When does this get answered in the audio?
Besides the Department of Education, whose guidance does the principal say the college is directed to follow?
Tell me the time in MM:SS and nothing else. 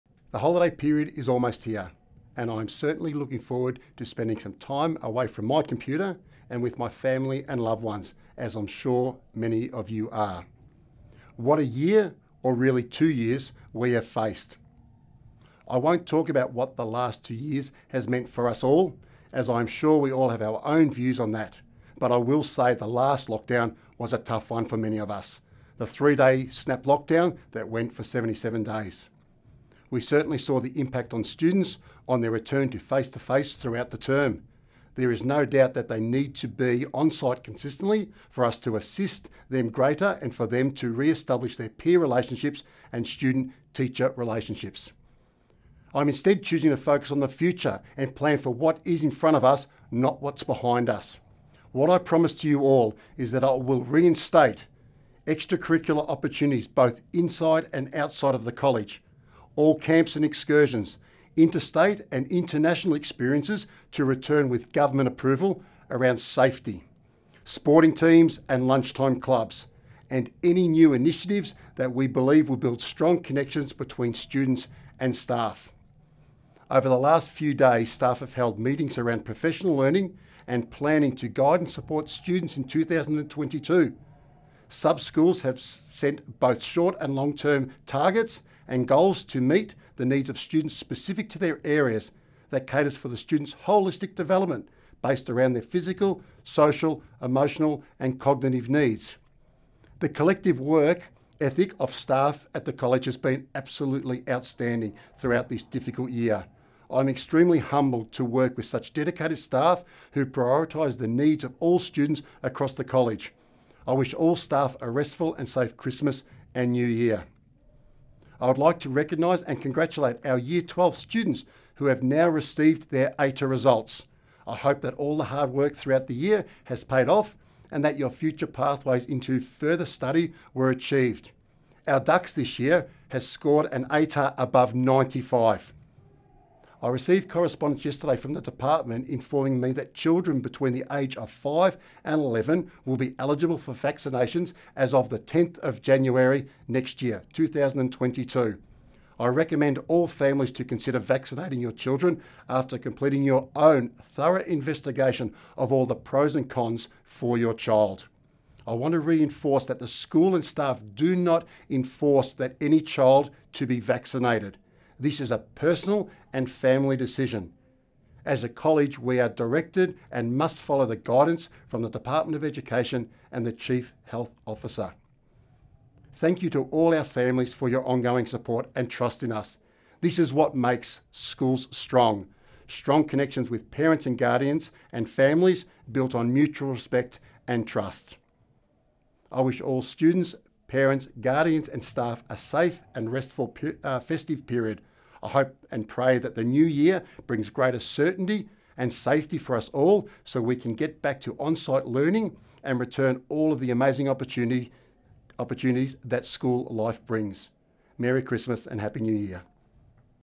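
02:53.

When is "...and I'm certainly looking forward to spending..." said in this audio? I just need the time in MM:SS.
00:02.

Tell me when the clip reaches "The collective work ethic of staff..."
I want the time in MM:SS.
01:39.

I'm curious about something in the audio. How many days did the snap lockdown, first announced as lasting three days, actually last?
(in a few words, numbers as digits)
77.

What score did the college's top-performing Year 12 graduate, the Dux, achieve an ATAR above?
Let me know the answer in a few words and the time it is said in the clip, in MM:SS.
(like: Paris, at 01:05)
95, at 02:14.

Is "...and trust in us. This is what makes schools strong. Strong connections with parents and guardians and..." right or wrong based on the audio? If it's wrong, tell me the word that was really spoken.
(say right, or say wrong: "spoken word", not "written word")
right.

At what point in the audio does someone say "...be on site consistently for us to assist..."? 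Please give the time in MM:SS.
00:36.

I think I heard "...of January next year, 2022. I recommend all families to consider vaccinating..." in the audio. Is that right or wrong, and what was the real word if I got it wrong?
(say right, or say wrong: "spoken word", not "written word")
right.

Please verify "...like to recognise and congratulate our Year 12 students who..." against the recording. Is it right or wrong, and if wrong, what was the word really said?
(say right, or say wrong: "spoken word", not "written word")
right.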